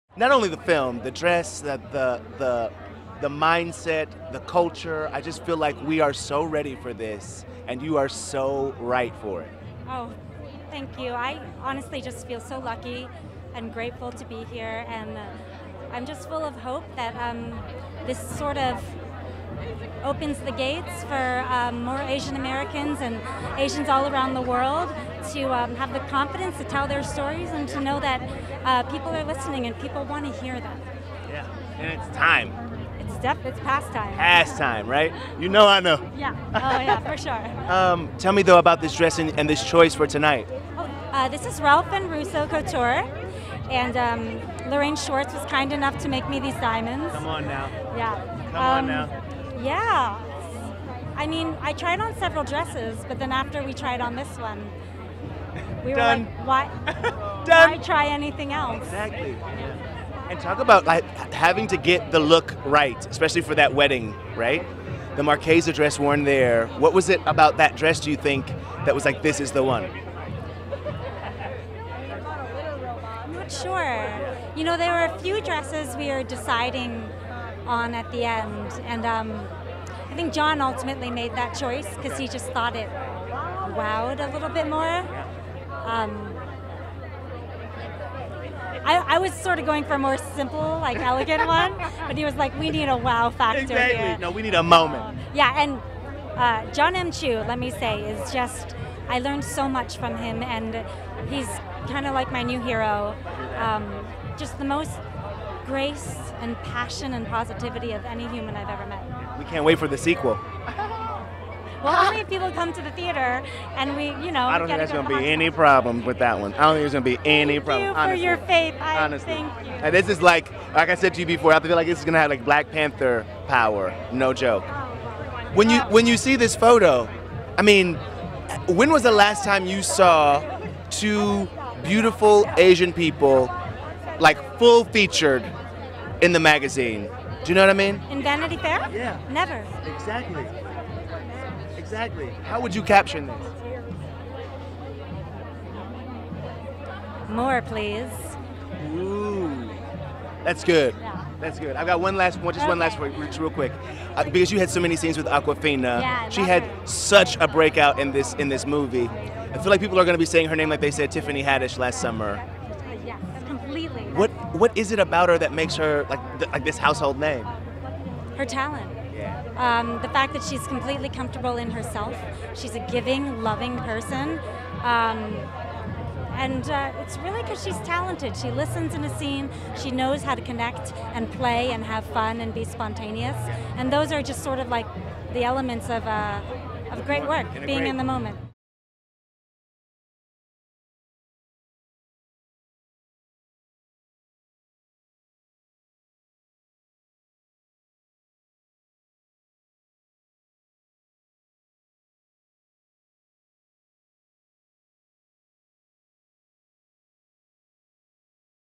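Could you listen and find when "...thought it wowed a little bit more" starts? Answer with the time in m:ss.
1:22.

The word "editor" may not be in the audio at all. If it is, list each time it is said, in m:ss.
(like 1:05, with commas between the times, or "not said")
not said.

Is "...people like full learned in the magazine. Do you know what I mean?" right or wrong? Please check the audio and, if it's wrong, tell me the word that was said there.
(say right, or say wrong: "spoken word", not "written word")
wrong: "featured", not "learned".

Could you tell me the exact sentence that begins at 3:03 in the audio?
And those are just sort of like the elements of, uh, of great work, being in the moment.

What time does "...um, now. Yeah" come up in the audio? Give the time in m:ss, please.
0:48.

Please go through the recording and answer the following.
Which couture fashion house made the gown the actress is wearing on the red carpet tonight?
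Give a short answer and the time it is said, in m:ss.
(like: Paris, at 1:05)
Ralph and Russo, at 0:41.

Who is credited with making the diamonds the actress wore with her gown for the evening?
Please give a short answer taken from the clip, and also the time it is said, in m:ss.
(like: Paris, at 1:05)
Lorraine Schwartz, at 0:44.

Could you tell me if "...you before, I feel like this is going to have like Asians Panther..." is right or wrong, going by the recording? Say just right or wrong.
wrong.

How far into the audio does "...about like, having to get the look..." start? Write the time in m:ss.
1:00.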